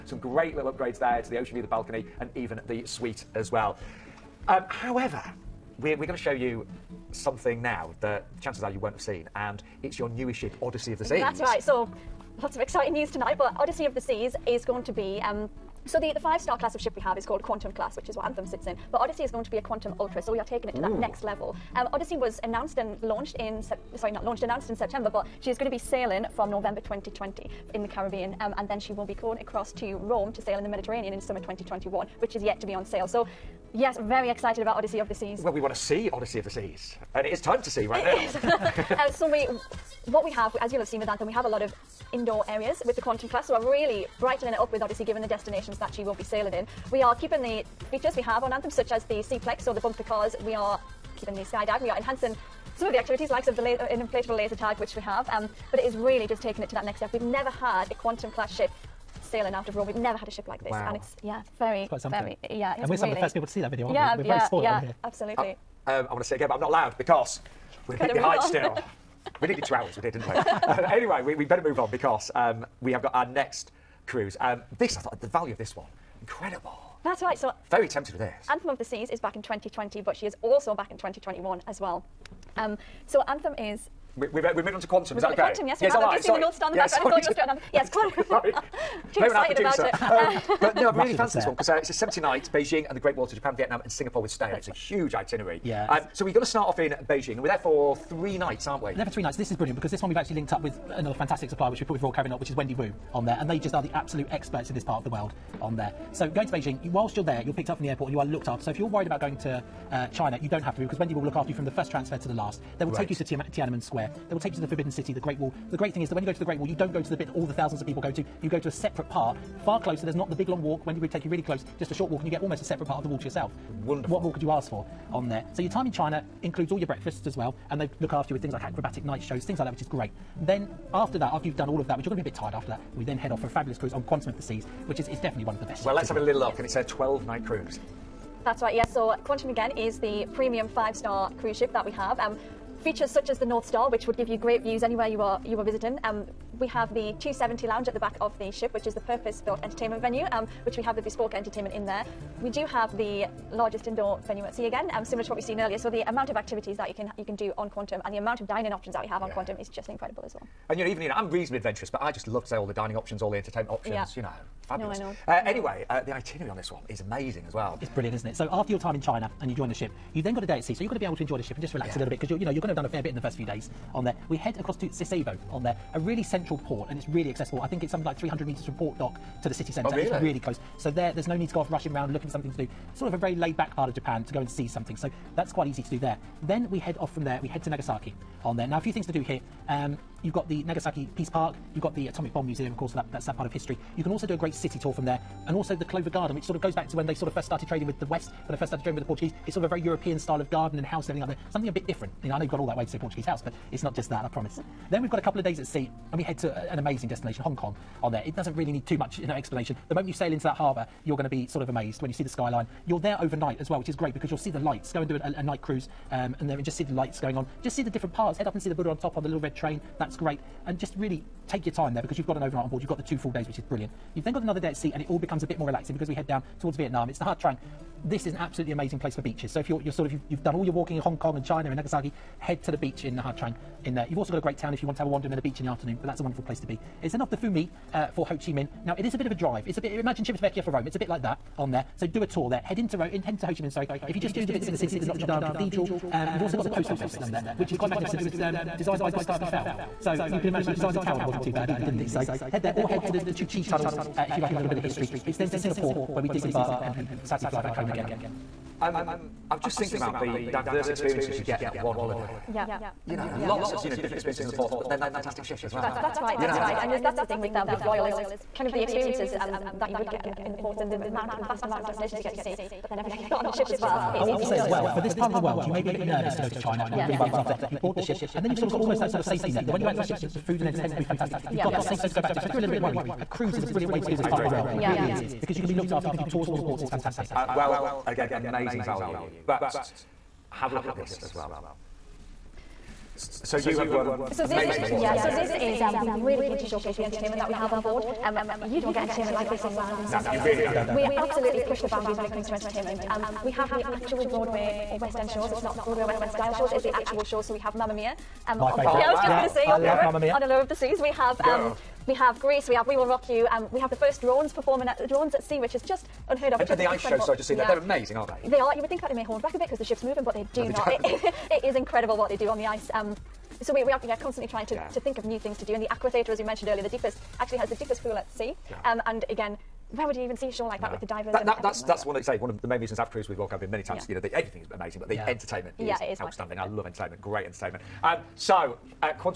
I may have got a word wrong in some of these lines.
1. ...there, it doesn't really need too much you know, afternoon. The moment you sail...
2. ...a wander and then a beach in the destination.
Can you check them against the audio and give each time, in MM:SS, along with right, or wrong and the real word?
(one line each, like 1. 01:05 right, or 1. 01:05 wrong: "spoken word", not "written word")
1. 03:28 wrong: "explanation", not "afternoon"
2. 03:55 wrong: "afternoon", not "destination".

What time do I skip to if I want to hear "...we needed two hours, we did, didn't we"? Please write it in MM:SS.
01:09.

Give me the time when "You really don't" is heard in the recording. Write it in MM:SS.
05:00.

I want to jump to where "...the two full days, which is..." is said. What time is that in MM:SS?
03:42.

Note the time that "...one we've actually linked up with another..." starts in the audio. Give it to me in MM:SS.
01:40.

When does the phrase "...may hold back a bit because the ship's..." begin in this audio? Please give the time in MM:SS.
05:19.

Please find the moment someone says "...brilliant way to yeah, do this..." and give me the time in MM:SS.
04:43.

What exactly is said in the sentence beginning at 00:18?
But Odyssey is going to be a Quantum Ultra, so we are taking it to Ooh.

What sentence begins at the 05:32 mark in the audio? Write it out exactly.
one of say one of the main reasons I've cruised with Royal Caribbean many times.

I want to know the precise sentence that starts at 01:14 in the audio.
Um, this, I thought, the value of this one, incredible.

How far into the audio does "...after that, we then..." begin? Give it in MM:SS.
02:12.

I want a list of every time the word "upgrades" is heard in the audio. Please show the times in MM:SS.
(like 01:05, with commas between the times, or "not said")
00:00.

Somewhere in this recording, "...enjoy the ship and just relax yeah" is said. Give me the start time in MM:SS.
02:51.